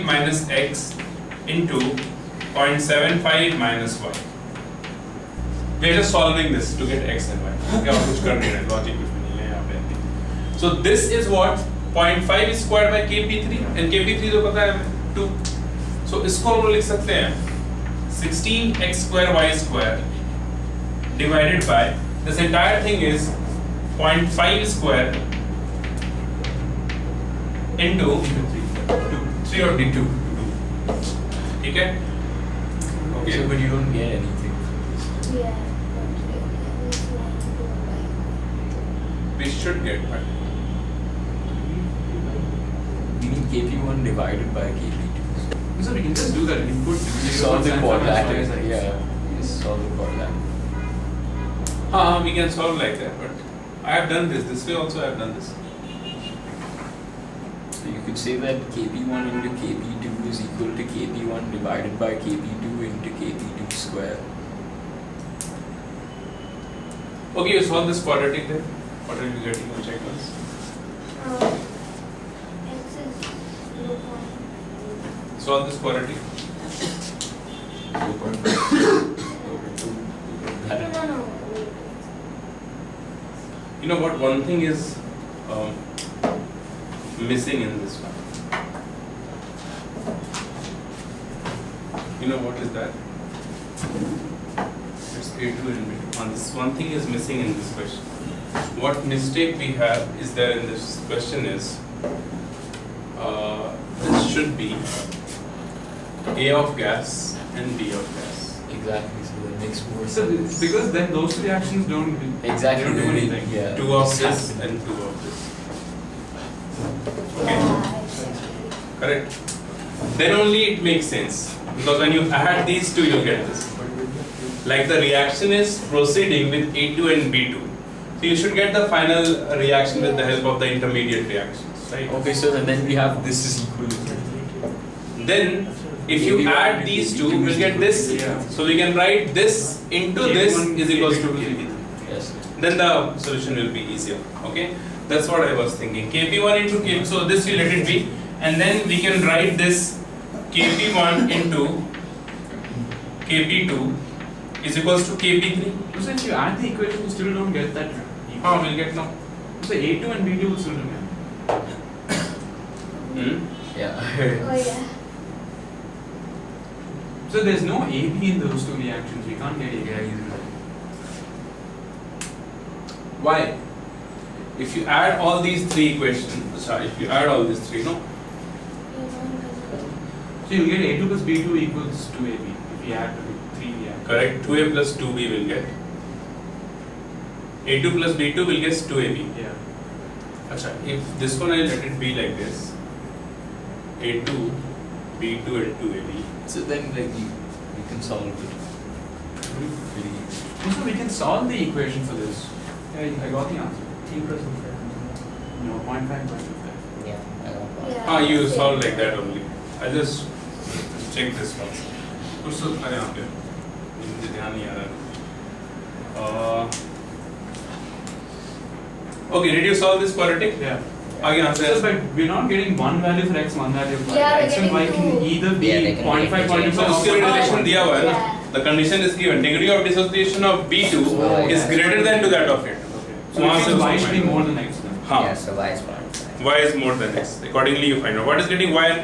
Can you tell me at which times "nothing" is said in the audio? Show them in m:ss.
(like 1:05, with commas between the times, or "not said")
not said.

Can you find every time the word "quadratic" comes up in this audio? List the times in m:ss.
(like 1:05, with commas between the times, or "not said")
1:08, 1:15, 3:40.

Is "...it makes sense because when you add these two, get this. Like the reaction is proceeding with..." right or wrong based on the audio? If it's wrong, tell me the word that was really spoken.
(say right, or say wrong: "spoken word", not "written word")
right.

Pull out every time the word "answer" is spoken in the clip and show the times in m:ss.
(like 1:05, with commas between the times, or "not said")
3:23, 3:41.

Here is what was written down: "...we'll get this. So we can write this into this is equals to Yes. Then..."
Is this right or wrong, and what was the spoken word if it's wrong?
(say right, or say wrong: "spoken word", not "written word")
right.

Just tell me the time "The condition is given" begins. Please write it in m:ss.
3:48.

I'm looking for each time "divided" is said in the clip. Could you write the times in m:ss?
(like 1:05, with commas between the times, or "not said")
0:21, 0:44, 1:01.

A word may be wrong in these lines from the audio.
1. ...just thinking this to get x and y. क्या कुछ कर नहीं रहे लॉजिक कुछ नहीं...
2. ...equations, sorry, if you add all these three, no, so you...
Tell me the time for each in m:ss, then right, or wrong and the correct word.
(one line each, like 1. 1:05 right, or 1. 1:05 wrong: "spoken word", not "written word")
1. 0:05 wrong: "solving", not "thinking"
2. 2:55 right.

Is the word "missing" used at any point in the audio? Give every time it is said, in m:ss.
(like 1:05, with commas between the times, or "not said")
1:27, 1:37.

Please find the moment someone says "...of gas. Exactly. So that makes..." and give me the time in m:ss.
1:47.